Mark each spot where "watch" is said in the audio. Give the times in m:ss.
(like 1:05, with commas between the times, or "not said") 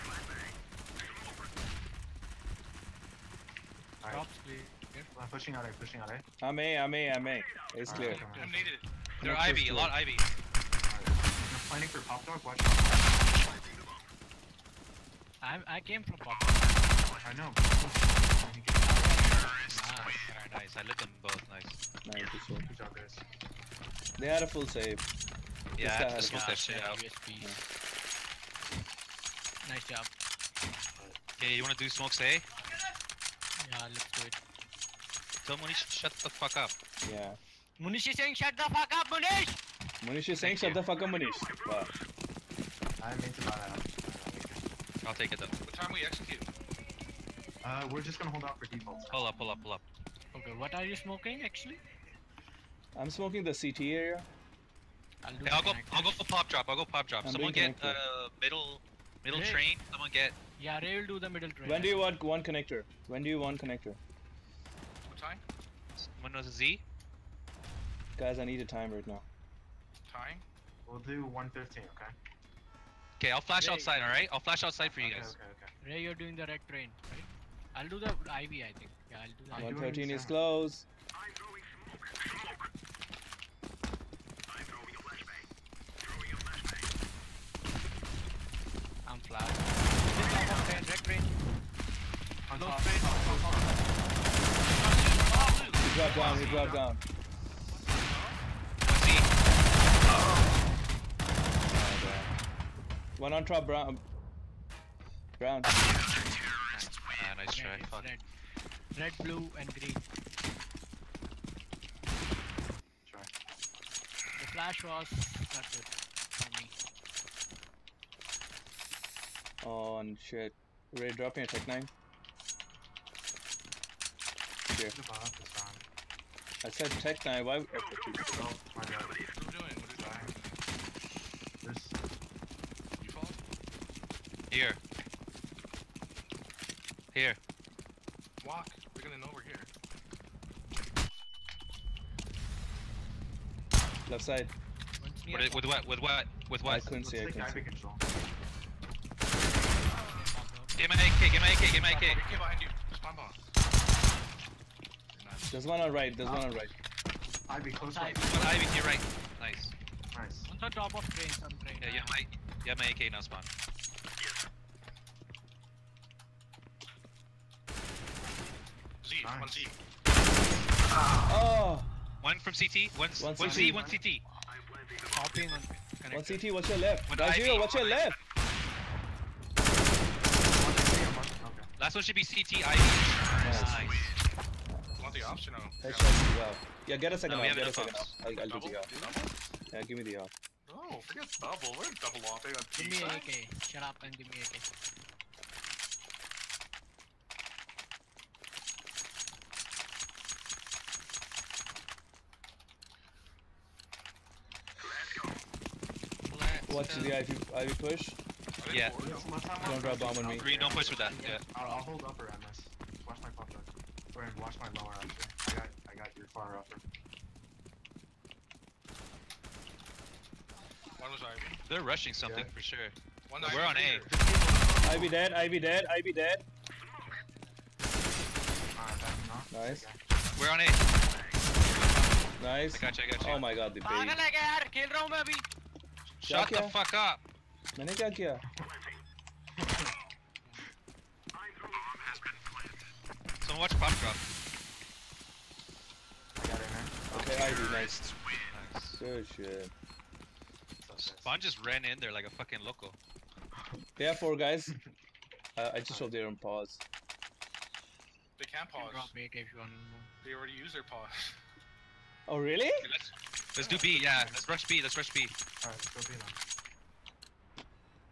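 0:12, 3:26, 3:34, 4:03.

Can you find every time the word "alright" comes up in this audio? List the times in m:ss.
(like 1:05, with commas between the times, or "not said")
1:14, 4:25.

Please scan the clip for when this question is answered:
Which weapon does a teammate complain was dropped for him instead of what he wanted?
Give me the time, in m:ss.
2:01.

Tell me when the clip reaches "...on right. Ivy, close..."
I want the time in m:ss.
2:36.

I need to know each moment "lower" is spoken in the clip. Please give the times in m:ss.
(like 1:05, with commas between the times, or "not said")
3:34.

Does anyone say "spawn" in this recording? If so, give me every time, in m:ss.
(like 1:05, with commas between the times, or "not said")
2:43, 4:10.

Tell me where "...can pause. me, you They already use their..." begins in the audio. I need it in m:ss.
4:18.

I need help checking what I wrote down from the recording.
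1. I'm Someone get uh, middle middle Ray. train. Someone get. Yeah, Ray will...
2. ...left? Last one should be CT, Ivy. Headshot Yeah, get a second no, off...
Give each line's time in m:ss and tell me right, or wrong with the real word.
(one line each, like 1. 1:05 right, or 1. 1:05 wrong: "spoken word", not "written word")
1. 0:57 right
2. 2:57 right.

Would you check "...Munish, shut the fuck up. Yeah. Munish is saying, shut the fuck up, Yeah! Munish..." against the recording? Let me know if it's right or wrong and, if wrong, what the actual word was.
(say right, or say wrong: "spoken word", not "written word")
wrong: "Munish", not "Yeah".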